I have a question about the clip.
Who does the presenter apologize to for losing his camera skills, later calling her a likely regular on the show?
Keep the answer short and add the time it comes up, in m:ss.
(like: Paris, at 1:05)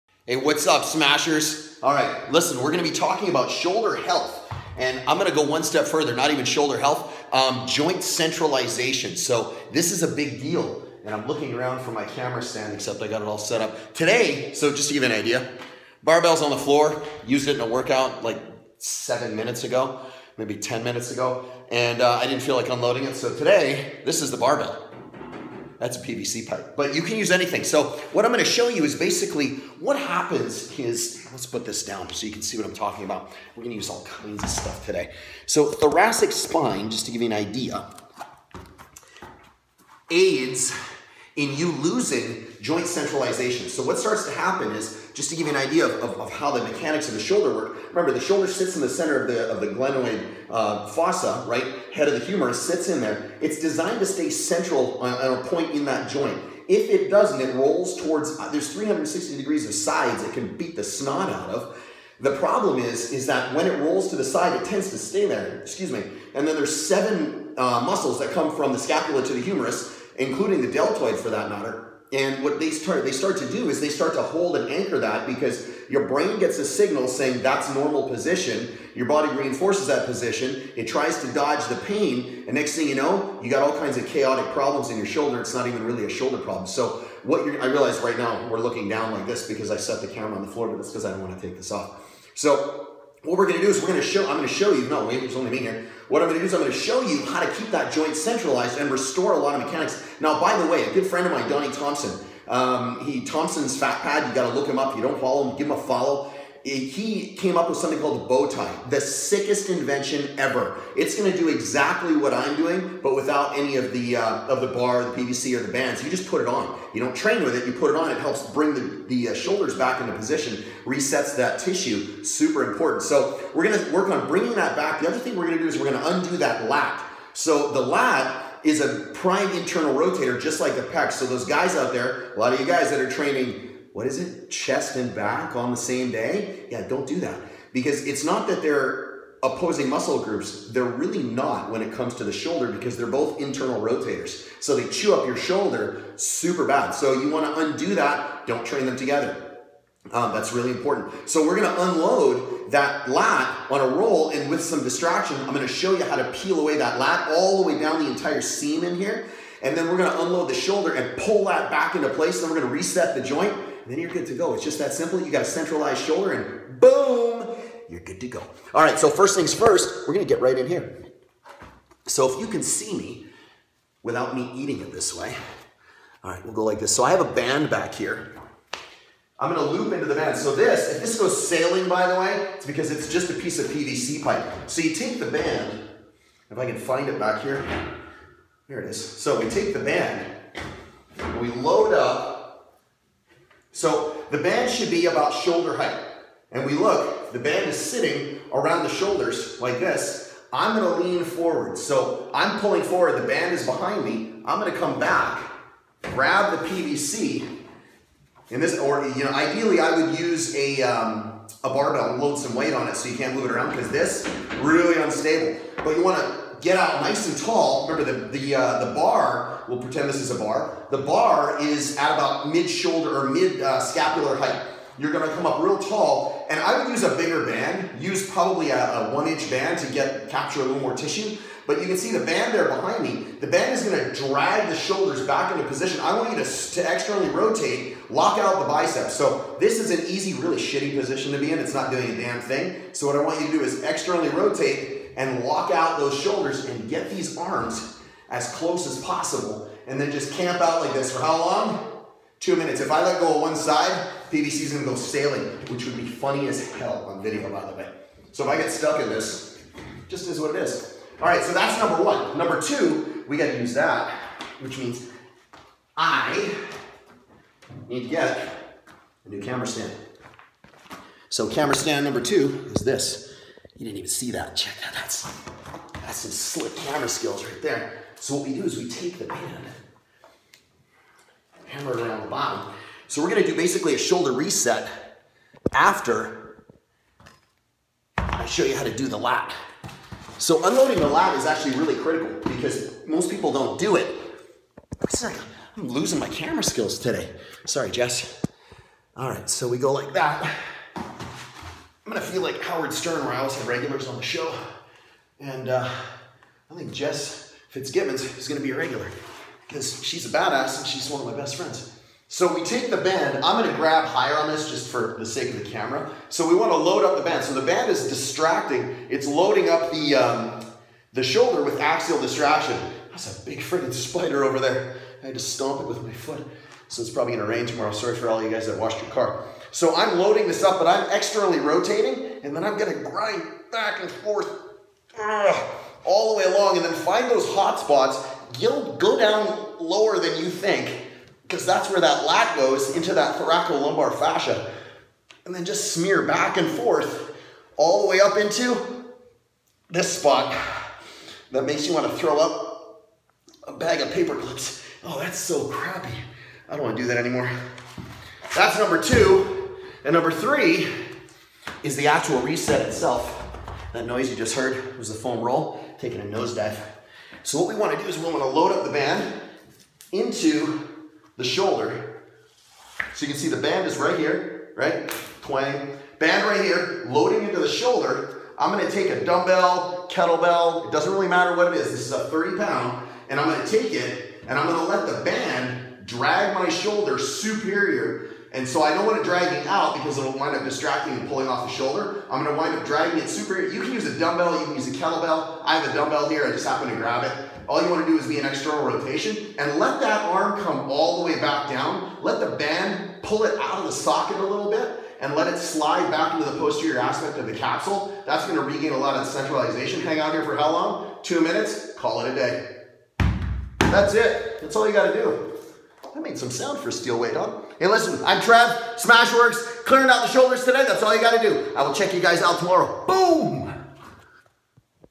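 Jess Fitzgibbons, at 5:06.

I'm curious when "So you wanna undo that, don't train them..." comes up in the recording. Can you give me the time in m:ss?
2:26.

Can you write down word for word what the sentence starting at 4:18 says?
So if I get stuck in this, just is what it is.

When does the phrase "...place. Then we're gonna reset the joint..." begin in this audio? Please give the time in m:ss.
2:42.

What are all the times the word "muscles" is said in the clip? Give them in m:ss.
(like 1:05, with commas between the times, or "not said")
1:07, 2:19.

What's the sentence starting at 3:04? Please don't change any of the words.
So you take the band, if I can find it back here, here it is.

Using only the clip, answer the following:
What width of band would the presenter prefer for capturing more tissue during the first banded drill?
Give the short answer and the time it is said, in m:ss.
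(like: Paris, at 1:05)
1 inch, at 3:49.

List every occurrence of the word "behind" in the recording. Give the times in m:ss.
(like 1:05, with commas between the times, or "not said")
3:23, 3:52.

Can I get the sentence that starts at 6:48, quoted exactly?
That's going to regain a lot of centralization.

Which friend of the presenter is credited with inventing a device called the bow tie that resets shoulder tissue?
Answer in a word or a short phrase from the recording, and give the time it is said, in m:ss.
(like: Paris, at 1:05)
Donnie Thompson, at 1:41.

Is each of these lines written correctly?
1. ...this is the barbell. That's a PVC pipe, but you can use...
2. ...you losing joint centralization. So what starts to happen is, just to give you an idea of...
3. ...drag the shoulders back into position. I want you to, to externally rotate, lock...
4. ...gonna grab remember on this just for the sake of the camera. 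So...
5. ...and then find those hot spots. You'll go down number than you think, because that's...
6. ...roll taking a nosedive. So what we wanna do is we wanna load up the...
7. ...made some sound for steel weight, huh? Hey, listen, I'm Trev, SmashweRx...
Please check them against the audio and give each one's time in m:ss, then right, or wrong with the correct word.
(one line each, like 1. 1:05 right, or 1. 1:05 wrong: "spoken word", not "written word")
1. 0:24 right
2. 0:41 right
3. 3:54 right
4. 5:13 wrong: "higher", not "remember"
5. 5:36 wrong: "lower", not "number"
6. 6:05 right
7. 6:56 right.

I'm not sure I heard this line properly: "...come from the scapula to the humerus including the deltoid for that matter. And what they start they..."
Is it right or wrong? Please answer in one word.
right.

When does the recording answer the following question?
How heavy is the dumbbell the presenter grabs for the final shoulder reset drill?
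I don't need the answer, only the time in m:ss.
6:22.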